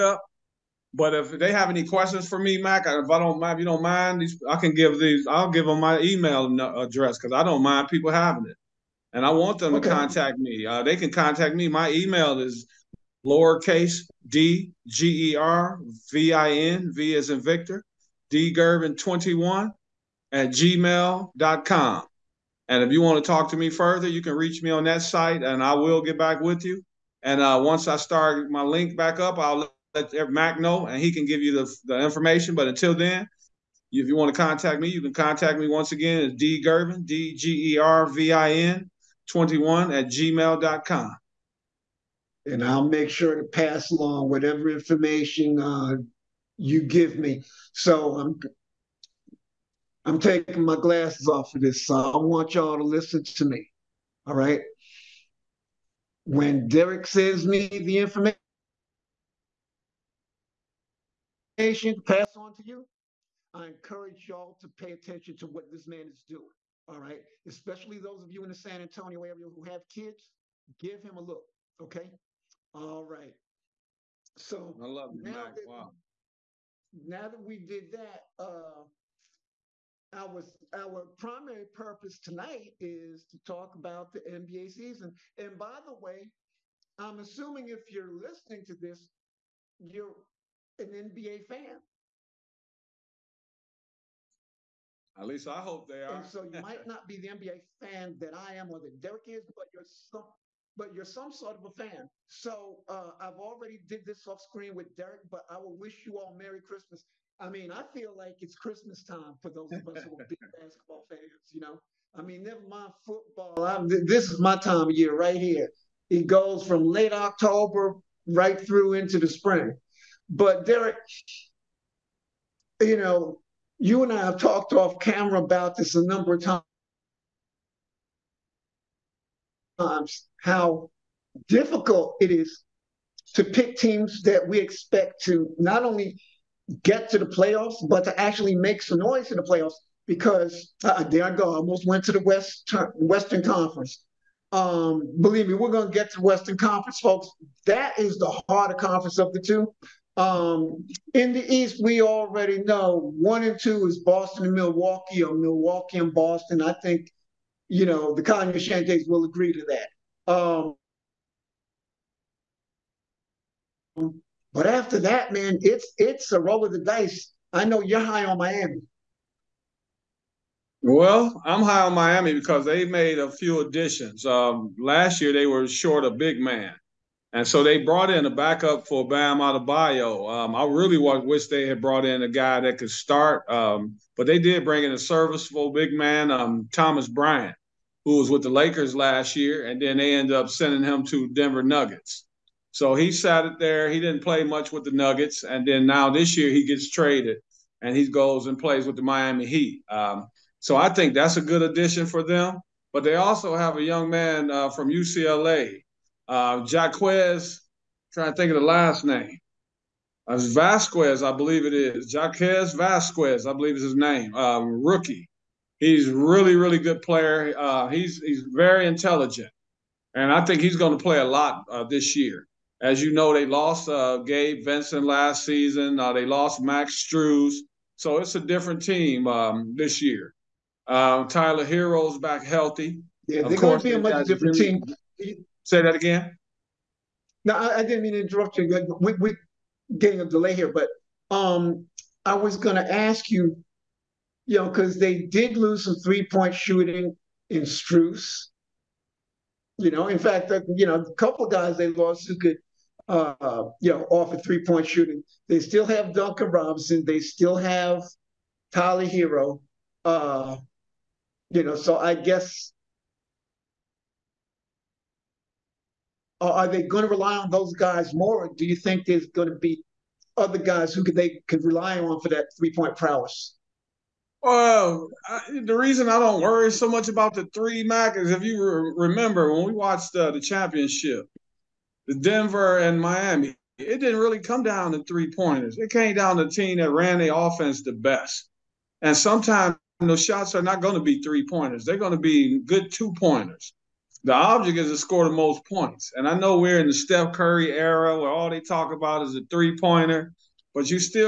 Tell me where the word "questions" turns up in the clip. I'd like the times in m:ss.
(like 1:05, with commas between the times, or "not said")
0:01.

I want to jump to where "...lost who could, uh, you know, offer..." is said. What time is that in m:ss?
4:11.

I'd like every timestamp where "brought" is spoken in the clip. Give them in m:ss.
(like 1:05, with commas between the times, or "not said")
2:57, 3:01.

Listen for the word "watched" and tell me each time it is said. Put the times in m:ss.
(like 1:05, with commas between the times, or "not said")
4:39.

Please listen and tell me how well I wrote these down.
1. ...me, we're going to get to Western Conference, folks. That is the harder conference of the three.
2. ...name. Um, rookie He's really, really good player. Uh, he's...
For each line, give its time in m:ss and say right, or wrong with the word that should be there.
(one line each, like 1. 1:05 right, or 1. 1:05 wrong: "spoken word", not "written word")
1. 2:25 wrong: "two", not "three"
2. 3:33 right.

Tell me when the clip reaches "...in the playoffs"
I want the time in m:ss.
2:19.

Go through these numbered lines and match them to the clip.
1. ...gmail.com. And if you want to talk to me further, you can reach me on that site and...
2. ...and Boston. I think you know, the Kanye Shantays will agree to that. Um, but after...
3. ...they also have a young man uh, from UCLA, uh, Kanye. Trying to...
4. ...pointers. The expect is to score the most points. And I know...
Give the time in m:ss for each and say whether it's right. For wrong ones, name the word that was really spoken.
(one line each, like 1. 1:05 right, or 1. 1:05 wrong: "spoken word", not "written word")
1. 0:20 right
2. 2:35 right
3. 3:23 wrong: "Jaquez", not "Kanye"
4. 4:53 wrong: "object", not "expect".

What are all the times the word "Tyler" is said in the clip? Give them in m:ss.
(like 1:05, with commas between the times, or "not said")
3:51, 4:18.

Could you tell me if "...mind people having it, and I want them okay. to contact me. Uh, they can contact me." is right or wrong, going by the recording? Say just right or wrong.
right.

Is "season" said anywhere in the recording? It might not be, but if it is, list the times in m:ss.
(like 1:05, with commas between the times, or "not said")
1:24, 3:45.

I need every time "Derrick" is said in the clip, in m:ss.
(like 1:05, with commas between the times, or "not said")
0:56, 1:38, 1:44, 2:00.